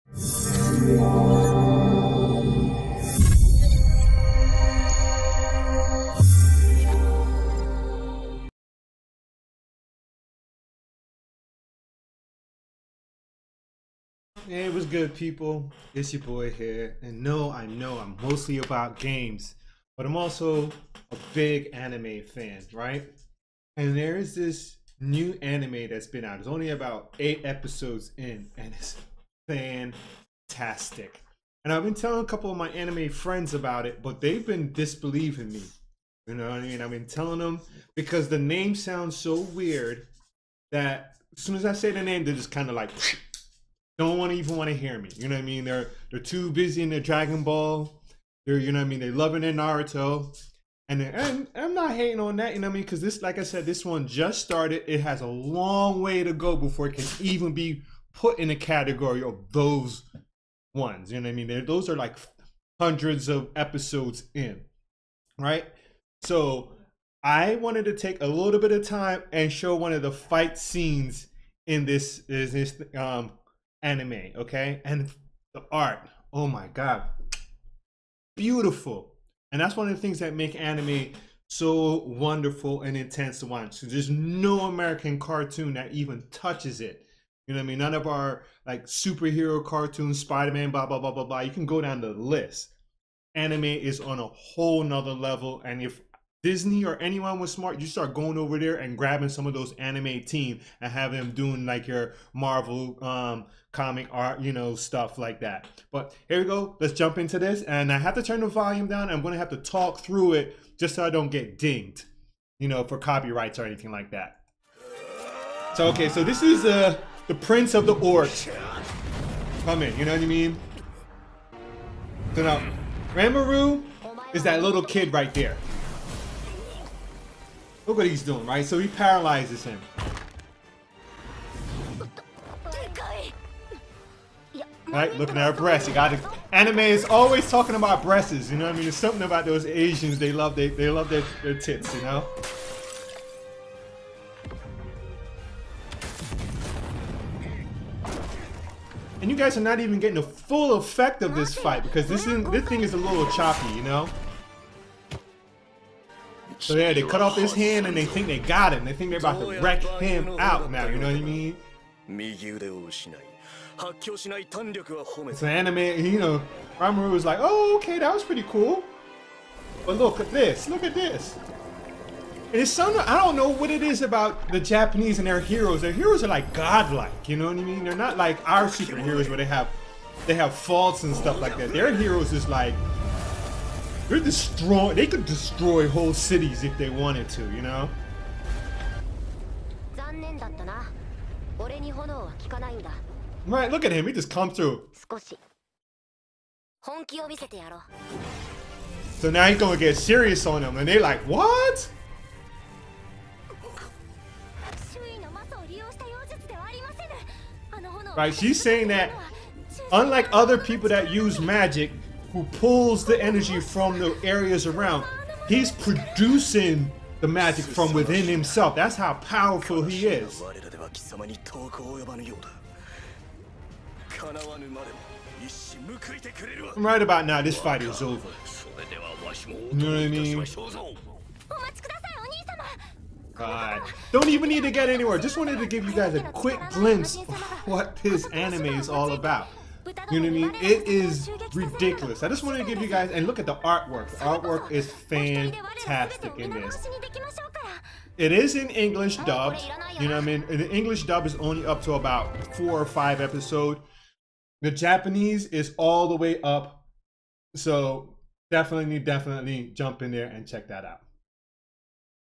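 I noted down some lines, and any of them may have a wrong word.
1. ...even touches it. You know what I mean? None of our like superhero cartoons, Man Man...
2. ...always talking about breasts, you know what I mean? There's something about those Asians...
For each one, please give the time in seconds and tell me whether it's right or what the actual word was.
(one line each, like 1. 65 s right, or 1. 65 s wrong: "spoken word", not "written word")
1. 85 s wrong: "Spider", not "Man"
2. 137 s right.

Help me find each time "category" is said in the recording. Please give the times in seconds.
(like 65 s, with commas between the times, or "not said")
58 s.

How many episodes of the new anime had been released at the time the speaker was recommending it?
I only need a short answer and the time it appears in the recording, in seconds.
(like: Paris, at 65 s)
8, at 27 s.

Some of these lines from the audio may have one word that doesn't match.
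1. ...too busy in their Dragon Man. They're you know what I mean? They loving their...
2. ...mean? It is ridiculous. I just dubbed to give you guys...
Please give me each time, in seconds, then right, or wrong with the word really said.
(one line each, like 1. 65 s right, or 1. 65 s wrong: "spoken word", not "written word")
1. 46 s wrong: "Ball", not "Man"
2. 240 s wrong: "wanted", not "dubbed".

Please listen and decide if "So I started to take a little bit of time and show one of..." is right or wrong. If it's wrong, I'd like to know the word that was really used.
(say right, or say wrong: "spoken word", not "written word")
wrong: "wanted", not "started".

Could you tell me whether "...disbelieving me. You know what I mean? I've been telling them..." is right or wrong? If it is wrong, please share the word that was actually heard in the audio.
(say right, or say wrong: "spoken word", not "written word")
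right.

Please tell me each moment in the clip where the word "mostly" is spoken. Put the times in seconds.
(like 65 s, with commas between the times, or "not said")
18 s.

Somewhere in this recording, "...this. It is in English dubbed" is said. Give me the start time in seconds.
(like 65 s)
246 s.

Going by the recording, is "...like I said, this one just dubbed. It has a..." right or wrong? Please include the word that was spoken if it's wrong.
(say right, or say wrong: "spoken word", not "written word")
wrong: "started", not "dubbed".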